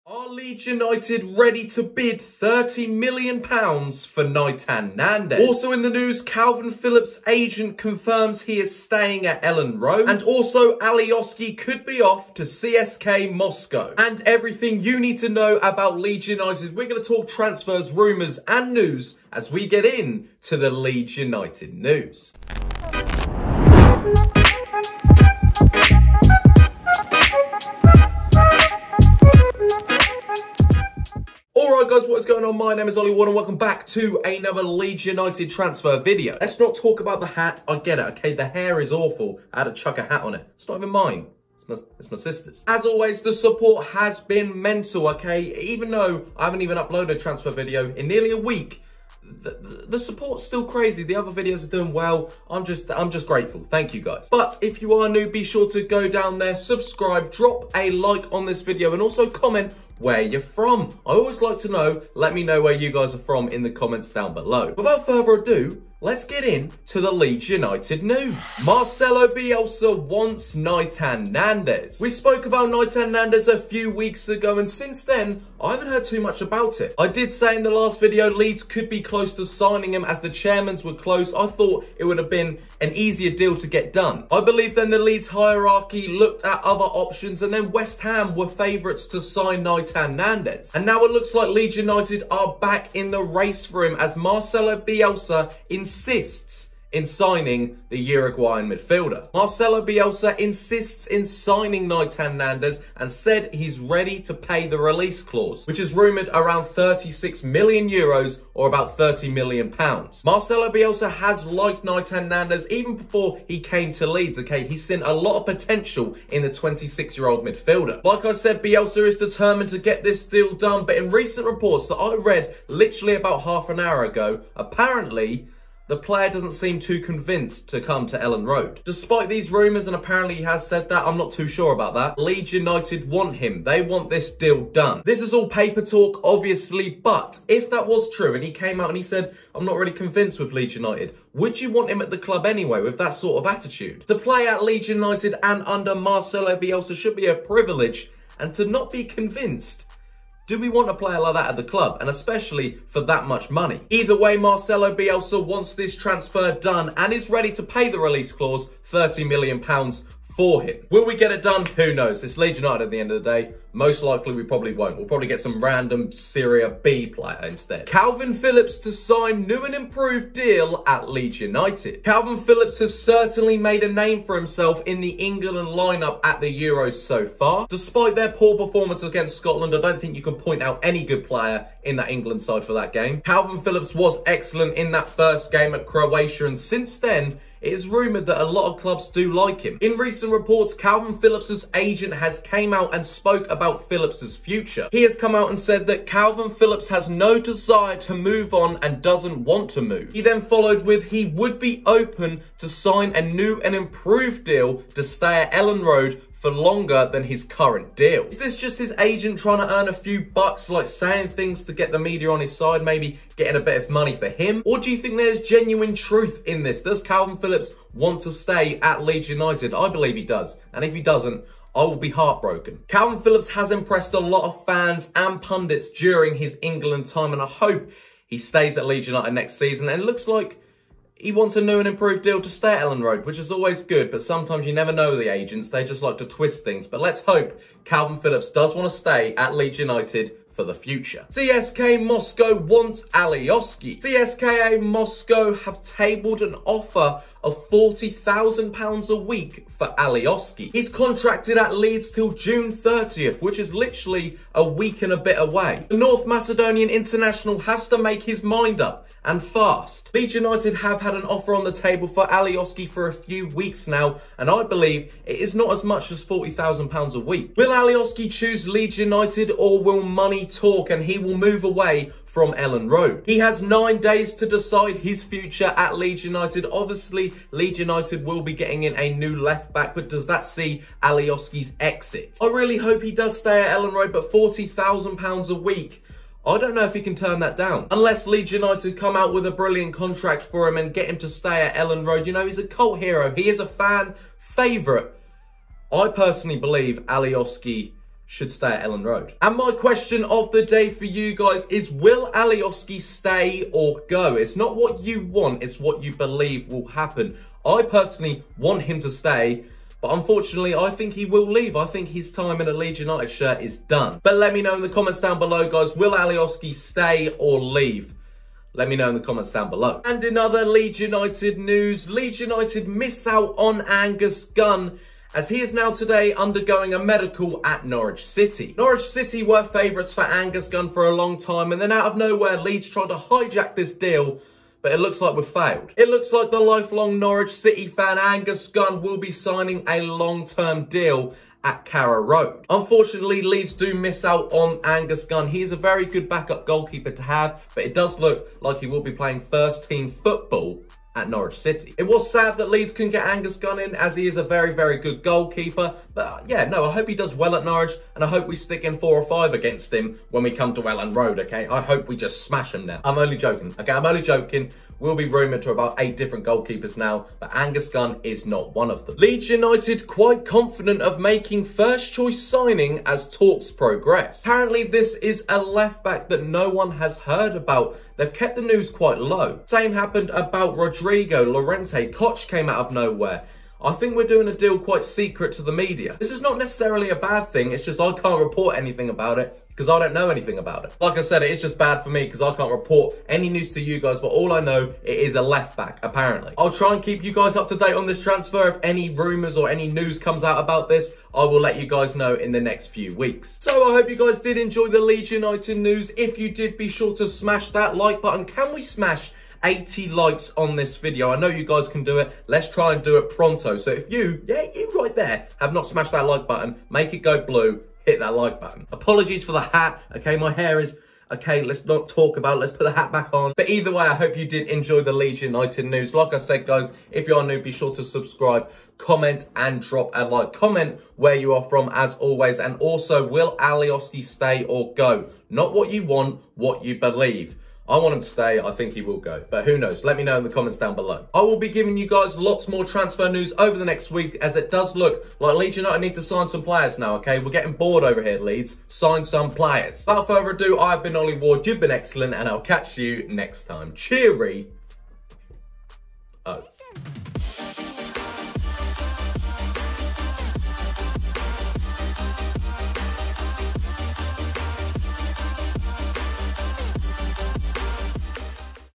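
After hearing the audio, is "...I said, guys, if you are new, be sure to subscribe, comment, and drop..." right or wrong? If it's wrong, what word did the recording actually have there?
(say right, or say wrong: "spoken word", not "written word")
right.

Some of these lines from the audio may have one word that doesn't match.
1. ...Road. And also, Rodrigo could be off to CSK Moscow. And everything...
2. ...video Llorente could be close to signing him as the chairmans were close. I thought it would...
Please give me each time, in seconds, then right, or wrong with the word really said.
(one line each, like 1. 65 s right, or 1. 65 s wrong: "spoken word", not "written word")
1. 9 s wrong: "Alioski", not "Rodrigo"
2. 77 s wrong: "Leeds", not "Llorente".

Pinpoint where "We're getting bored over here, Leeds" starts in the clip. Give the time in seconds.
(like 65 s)
447 s.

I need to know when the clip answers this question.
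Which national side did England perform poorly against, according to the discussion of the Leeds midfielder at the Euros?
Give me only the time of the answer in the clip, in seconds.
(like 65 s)
179 s.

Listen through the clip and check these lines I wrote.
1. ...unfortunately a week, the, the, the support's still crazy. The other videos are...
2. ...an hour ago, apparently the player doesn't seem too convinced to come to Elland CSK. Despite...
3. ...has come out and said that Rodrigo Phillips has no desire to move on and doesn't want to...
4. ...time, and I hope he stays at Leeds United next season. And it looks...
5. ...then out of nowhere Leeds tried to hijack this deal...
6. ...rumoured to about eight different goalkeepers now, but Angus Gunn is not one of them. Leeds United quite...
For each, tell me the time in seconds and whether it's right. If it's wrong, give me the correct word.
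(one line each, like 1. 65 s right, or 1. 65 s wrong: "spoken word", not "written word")
1. 48 s wrong: "nearly", not "unfortunately"
2. 123 s wrong: "Road", not "CSK"
3. 195 s wrong: "Kalvin", not "Rodrigo"
4. 227 s right
5. 331 s right
6. 365 s right.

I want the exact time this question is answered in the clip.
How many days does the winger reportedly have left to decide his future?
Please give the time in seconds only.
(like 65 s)
273 s.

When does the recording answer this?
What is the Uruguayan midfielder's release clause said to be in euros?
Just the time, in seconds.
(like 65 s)
106 s.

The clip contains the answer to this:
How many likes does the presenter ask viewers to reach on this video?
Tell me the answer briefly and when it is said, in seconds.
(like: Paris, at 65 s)
80, at 409 s.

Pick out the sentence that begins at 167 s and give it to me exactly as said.
Kalvin Phillips to sign new and improved deal at Leeds United.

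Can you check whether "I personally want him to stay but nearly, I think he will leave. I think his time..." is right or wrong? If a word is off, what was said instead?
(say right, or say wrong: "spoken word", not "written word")
wrong: "unfortunately", not "nearly".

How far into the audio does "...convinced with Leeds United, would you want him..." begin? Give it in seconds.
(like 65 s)
139 s.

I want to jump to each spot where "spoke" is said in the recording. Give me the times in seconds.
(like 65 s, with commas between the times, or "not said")
72 s, 193 s.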